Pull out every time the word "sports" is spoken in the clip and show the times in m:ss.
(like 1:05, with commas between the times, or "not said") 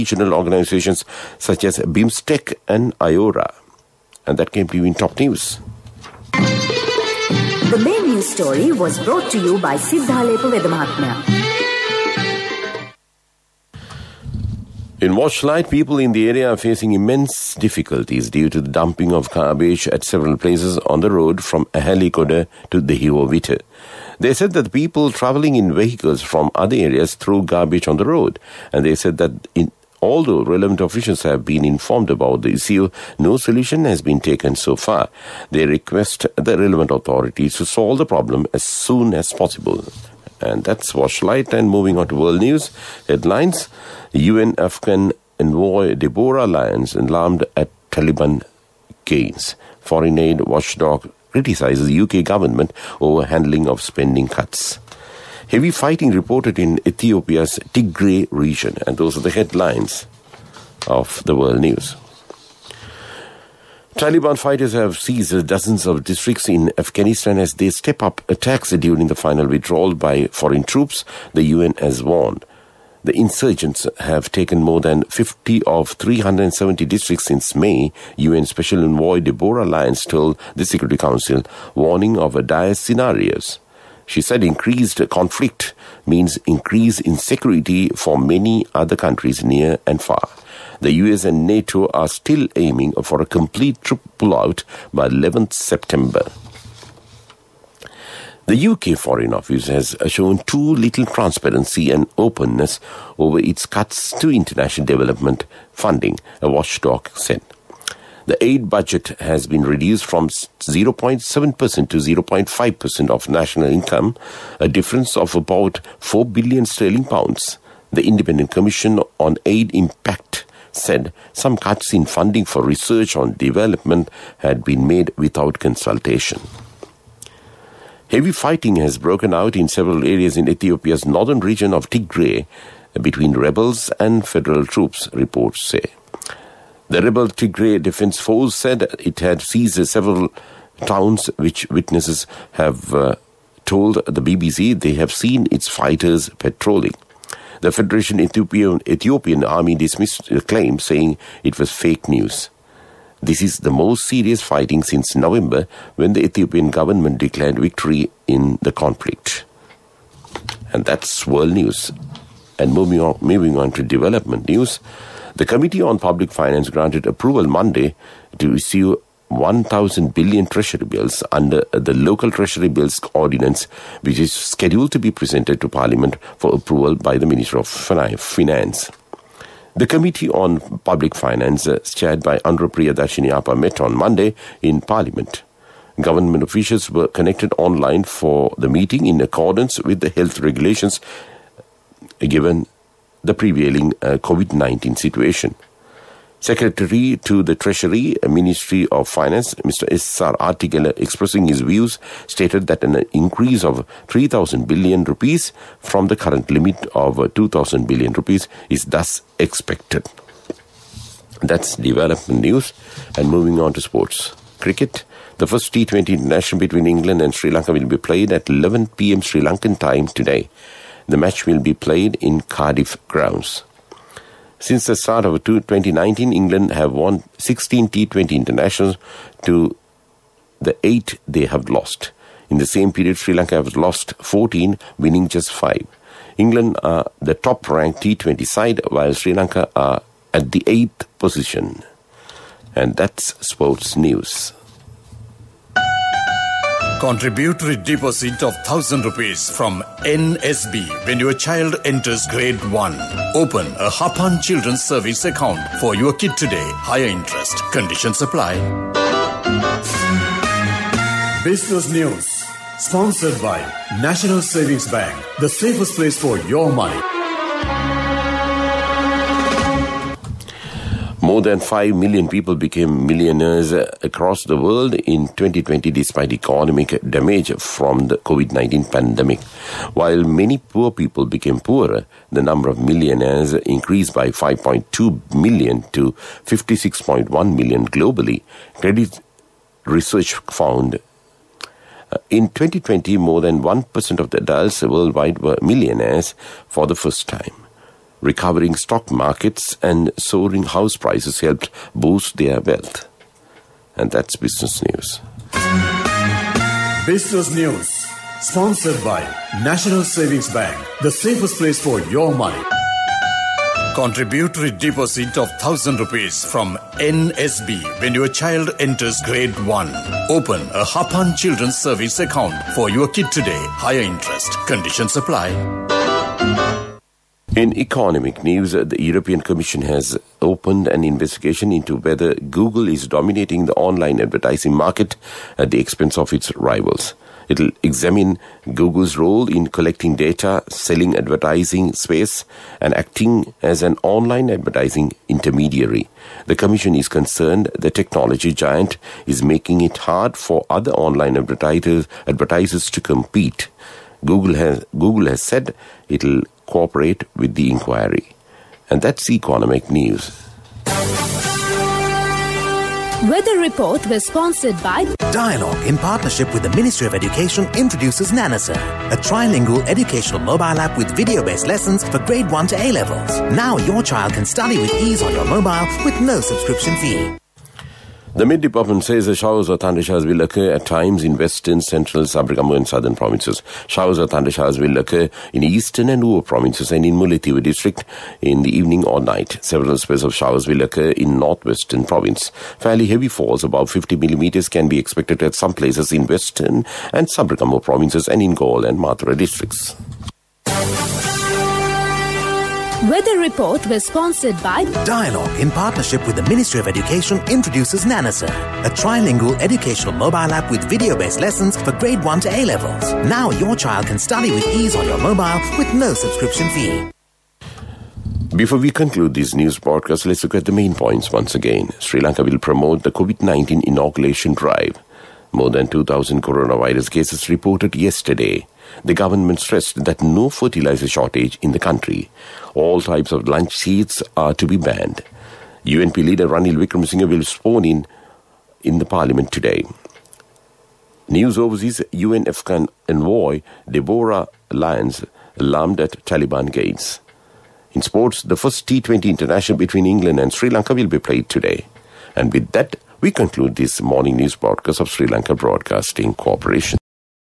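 3:33, 4:03, 7:28.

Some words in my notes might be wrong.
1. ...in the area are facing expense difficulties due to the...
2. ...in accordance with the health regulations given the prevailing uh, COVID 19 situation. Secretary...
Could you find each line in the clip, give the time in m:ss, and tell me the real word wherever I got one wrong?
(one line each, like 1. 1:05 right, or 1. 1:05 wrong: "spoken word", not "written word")
1. 0:15 wrong: "immense", not "expense"
2. 3:09 right.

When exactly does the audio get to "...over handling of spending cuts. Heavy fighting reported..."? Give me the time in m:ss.
0:53.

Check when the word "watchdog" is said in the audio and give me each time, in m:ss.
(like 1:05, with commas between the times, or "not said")
0:50, 1:46.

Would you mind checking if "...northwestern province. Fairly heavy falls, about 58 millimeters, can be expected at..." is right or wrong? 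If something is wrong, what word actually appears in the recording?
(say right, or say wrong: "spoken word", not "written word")
wrong: "50", not "58".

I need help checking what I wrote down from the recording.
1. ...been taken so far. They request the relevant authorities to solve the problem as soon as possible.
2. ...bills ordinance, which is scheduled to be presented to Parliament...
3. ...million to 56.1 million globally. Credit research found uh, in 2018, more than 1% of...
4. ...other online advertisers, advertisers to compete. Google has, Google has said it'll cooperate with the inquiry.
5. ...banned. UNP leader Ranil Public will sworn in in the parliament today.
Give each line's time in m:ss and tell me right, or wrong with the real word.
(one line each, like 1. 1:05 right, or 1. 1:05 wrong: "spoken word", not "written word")
1. 0:34 right
2. 2:52 right
3. 4:45 wrong: "2020", not "2018"
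4. 5:50 right
5. 7:14 wrong: "Wickremesinghe", not "Public".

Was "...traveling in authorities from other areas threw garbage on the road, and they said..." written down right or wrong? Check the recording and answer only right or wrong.
wrong.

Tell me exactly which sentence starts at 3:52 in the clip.
In the same period, Sri Lanka has lost 14, winning just 5.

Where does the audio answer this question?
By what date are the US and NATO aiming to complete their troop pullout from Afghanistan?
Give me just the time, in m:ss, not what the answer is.
1:35.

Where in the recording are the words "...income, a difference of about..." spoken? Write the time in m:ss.
1:53.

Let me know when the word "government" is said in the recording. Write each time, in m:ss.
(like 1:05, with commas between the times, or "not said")
0:52, 2:36, 3:06, 7:09.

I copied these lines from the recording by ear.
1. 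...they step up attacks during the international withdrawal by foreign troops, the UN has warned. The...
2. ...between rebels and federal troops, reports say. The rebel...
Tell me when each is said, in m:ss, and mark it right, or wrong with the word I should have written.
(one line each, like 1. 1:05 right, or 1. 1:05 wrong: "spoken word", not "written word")
1. 1:07 wrong: "final", not "international"
2. 2:13 right.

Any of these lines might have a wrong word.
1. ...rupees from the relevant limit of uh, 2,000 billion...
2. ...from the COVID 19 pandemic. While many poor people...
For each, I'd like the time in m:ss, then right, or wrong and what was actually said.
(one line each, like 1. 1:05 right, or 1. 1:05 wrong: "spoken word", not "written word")
1. 3:25 wrong: "current", not "relevant"
2. 4:37 right.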